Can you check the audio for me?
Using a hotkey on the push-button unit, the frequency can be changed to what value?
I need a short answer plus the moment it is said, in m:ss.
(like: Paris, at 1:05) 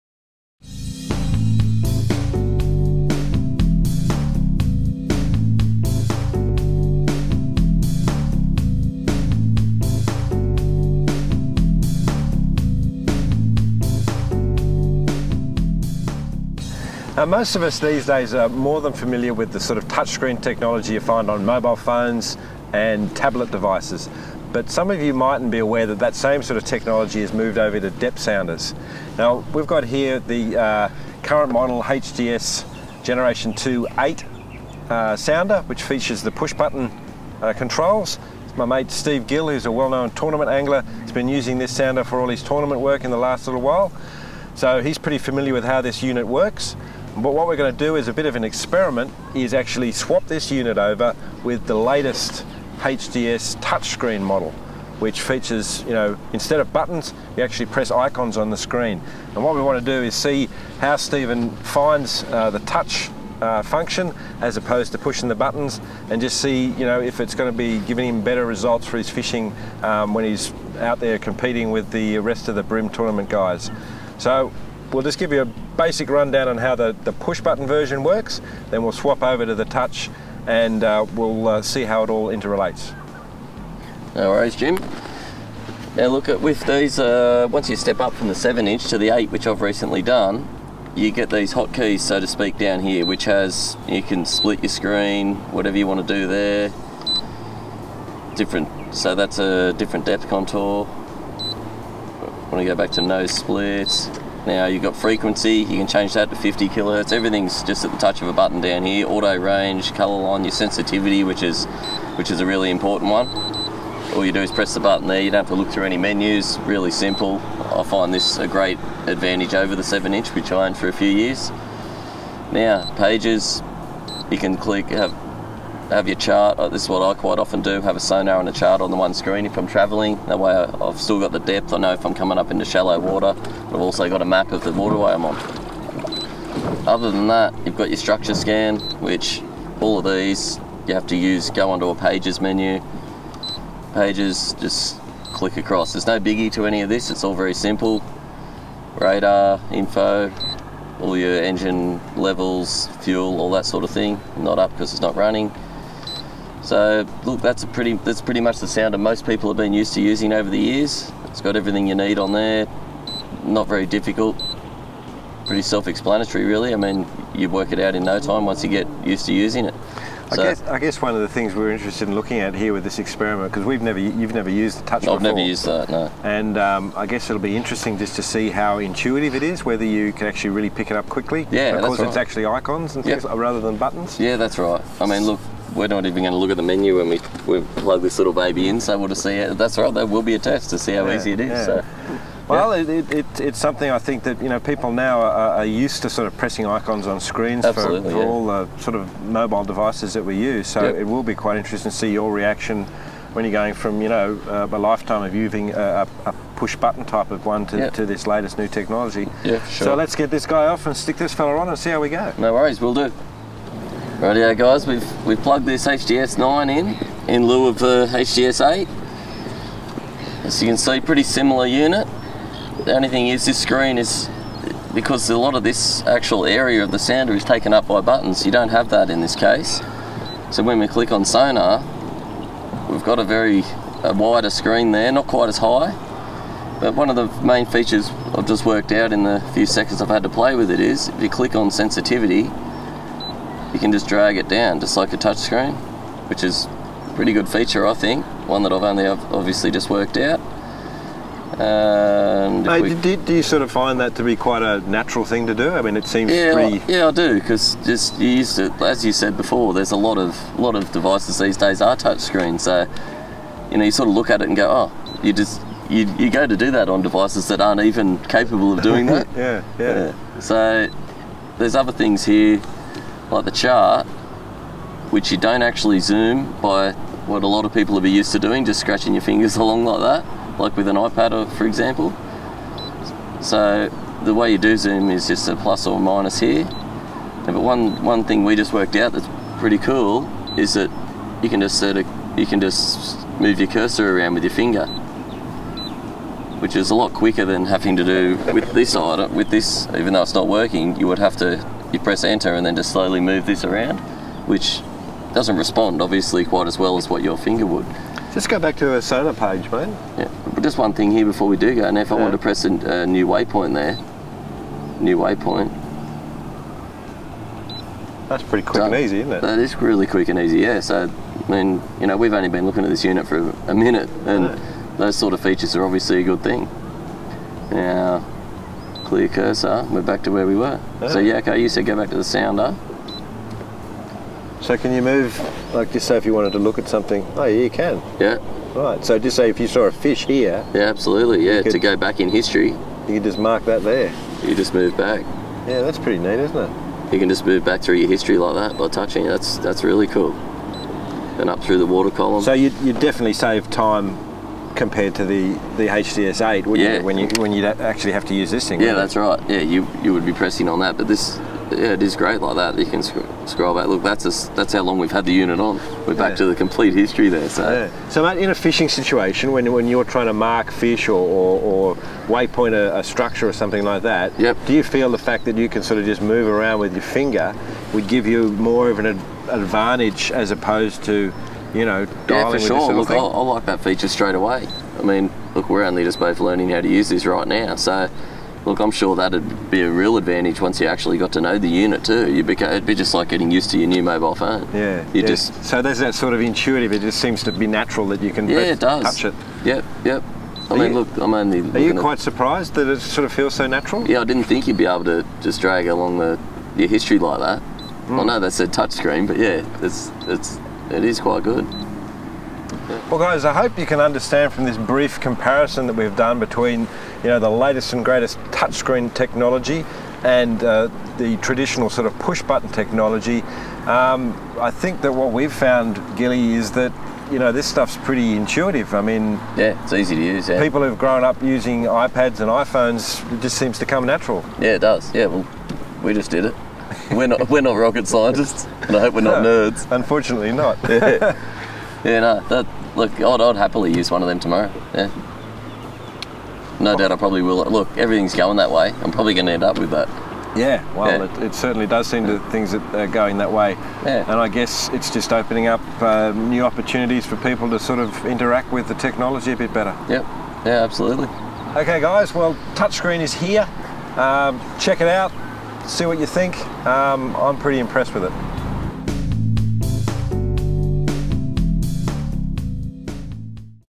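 50 kilohertz, at 1:46.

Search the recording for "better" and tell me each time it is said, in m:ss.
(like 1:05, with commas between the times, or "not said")
1:08, 7:39.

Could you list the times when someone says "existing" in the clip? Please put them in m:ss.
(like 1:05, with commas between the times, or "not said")
not said.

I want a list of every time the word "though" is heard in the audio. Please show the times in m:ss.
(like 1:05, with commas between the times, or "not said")
5:00.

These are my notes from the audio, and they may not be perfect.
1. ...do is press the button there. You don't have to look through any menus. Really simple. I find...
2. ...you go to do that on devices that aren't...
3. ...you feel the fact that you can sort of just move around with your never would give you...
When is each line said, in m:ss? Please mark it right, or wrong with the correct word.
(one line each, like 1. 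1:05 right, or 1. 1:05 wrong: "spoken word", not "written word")
1. 1:54 right
2. 4:26 right
3. 6:14 wrong: "finger", not "never".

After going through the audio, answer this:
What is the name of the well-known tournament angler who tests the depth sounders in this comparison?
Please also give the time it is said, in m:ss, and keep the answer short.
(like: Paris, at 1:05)
Steve Gill, at 0:38.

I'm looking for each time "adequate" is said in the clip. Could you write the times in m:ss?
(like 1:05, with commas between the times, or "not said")
not said.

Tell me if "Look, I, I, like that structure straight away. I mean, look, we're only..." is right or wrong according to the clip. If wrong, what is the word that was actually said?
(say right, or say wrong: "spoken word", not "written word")
wrong: "feature", not "structure".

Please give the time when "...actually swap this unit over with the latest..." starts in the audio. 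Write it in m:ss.
0:49.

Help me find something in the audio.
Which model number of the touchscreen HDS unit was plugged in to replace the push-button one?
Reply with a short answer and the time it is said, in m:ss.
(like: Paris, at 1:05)
HDS 9, at 3:35.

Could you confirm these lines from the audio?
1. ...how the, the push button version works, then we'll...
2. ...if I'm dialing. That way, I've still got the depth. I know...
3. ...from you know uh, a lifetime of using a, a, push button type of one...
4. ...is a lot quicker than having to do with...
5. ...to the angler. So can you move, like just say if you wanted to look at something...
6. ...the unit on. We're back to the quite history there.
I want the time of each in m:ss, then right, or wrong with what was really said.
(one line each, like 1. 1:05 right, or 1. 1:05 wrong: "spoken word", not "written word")
1. 1:16 right
2. 2:09 wrong: "travelling", not "dialing"
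3. 3:23 right
4. 4:56 right
5. 5:32 wrong: "sounder", not "angler"
6. 6:05 wrong: "complete", not "quite".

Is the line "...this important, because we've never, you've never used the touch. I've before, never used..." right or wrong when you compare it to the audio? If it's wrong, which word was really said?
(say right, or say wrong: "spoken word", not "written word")
wrong: "experiment", not "important".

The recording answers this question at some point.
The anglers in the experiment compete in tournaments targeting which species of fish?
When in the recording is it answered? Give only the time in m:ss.
1:12.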